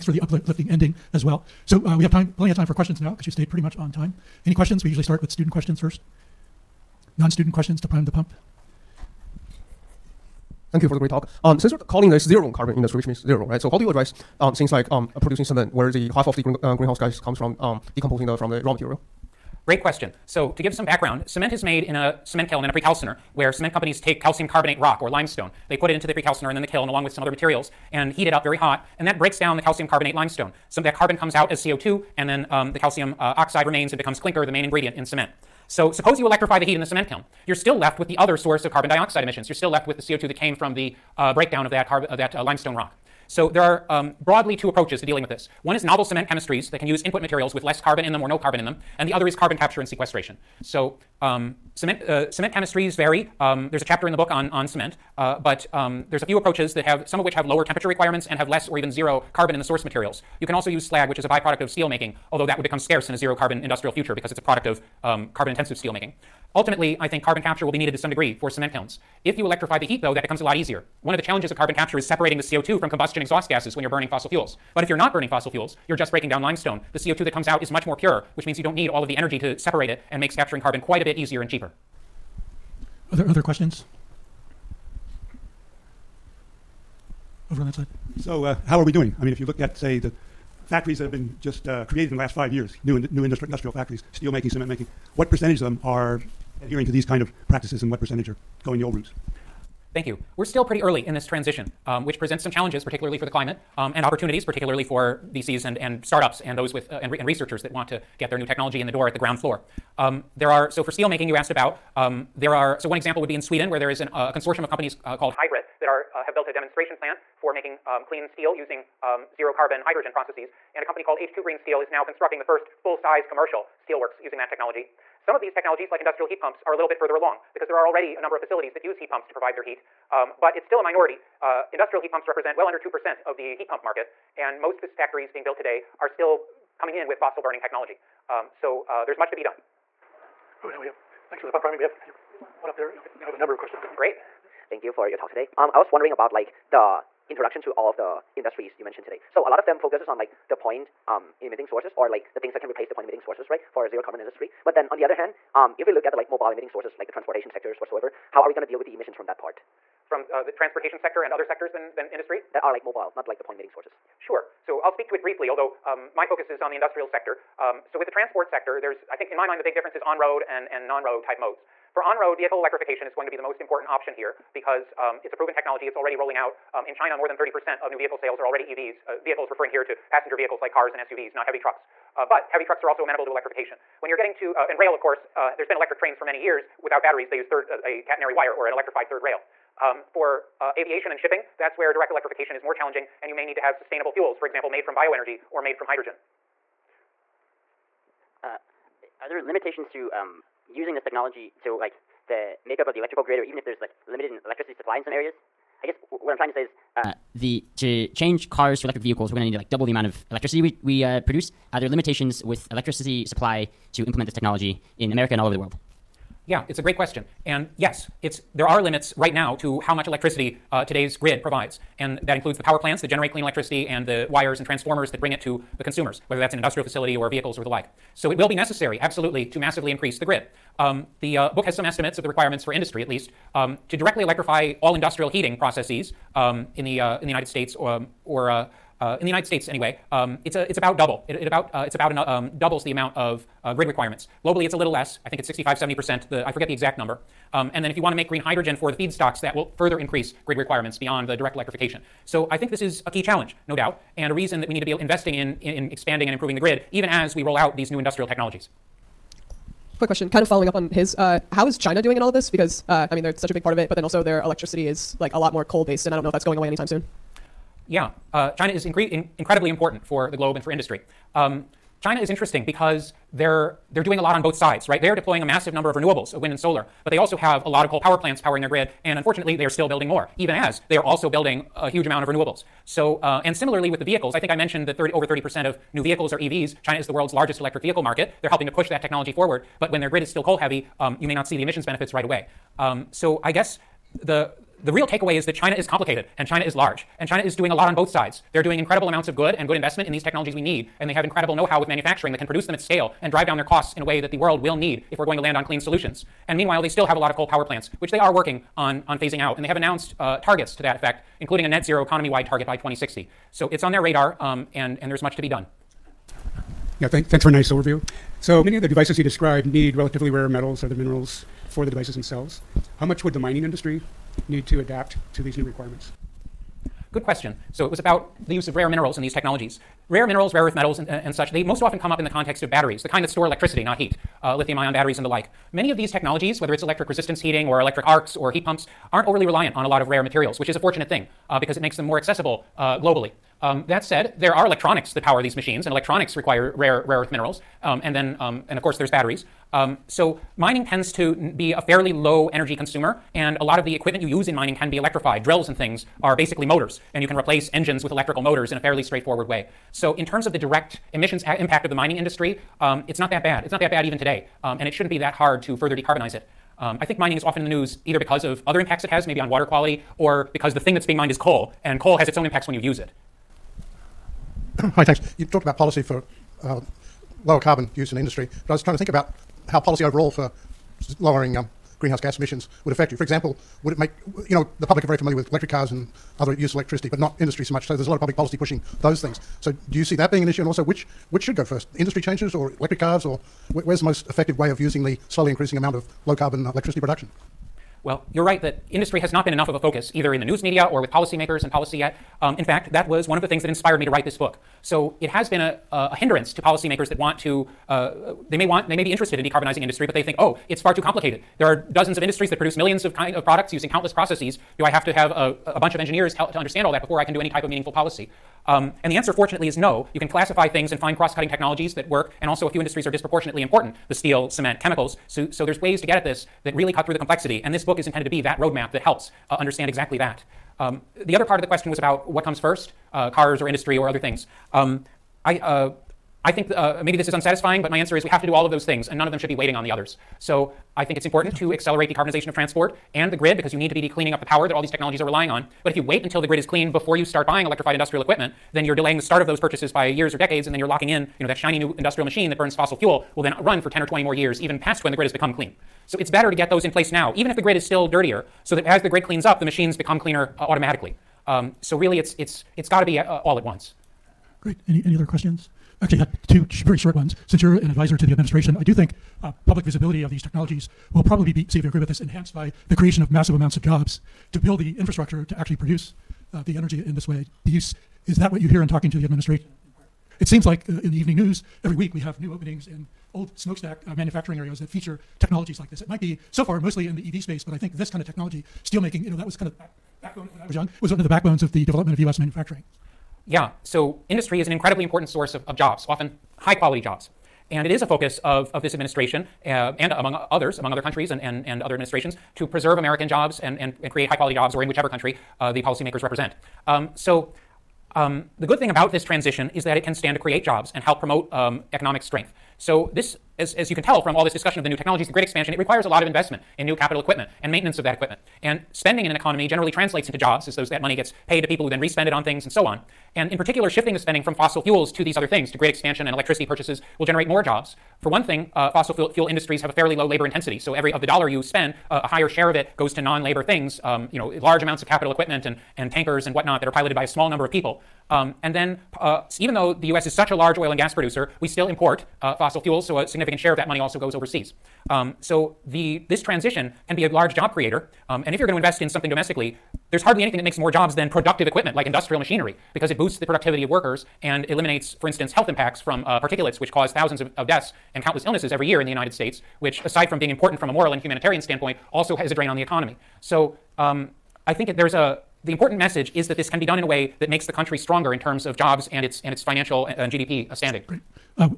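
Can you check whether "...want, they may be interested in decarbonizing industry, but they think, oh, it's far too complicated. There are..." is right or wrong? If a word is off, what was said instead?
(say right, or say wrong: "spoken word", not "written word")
right.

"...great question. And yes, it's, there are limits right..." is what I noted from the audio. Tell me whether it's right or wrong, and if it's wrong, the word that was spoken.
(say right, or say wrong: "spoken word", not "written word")
right.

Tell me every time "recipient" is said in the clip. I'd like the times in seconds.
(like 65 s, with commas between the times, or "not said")
not said.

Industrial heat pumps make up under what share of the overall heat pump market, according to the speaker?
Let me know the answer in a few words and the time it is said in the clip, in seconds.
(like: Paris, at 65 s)
2%, at 132 s.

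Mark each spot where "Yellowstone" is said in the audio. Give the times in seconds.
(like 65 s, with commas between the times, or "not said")
not said.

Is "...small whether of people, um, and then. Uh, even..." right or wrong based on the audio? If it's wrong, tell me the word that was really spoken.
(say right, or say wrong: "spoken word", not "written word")
wrong: "number", not "whether".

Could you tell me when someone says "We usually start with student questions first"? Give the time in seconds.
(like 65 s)
4 s.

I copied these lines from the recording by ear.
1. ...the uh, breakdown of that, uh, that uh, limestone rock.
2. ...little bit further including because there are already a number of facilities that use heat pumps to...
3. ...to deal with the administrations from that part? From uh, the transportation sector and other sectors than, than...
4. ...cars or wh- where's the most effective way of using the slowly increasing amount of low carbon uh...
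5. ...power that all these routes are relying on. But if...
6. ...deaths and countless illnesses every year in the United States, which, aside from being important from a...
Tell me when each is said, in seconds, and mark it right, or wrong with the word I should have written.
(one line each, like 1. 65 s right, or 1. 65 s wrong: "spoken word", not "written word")
1. 40 s right
2. 126 s wrong: "along", not "including"
3. 158 s wrong: "emissions", not "administrations"
4. 392 s right
5. 444 s wrong: "technologies", not "routes"
6. 557 s right.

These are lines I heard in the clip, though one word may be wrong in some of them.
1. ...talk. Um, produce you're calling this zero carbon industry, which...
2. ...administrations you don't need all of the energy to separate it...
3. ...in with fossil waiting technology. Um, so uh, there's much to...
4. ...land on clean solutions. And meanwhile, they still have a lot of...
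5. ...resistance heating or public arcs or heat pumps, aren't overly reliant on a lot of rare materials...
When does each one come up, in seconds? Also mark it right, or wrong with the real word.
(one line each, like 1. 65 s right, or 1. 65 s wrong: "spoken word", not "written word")
1. 11 s wrong: "since", not "produce"
2. 78 s wrong: "means", not "administrations"
3. 136 s wrong: "burning", not "waiting"
4. 305 s right
5. 337 s wrong: "electric", not "public".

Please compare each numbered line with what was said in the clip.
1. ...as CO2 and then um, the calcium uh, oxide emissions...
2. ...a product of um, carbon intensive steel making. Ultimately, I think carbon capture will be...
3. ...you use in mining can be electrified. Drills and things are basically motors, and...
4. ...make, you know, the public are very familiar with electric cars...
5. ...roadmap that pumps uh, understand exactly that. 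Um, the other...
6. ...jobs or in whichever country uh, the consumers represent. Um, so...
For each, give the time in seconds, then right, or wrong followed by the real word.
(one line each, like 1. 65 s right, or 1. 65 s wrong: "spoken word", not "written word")
1. 31 s wrong: "remains", not "emissions"
2. 64 s right
3. 354 s right
4. 383 s right
5. 428 s wrong: "helps", not "pumps"
6. 504 s wrong: "policymakers", not "consumers".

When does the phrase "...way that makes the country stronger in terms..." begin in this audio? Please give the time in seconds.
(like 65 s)
567 s.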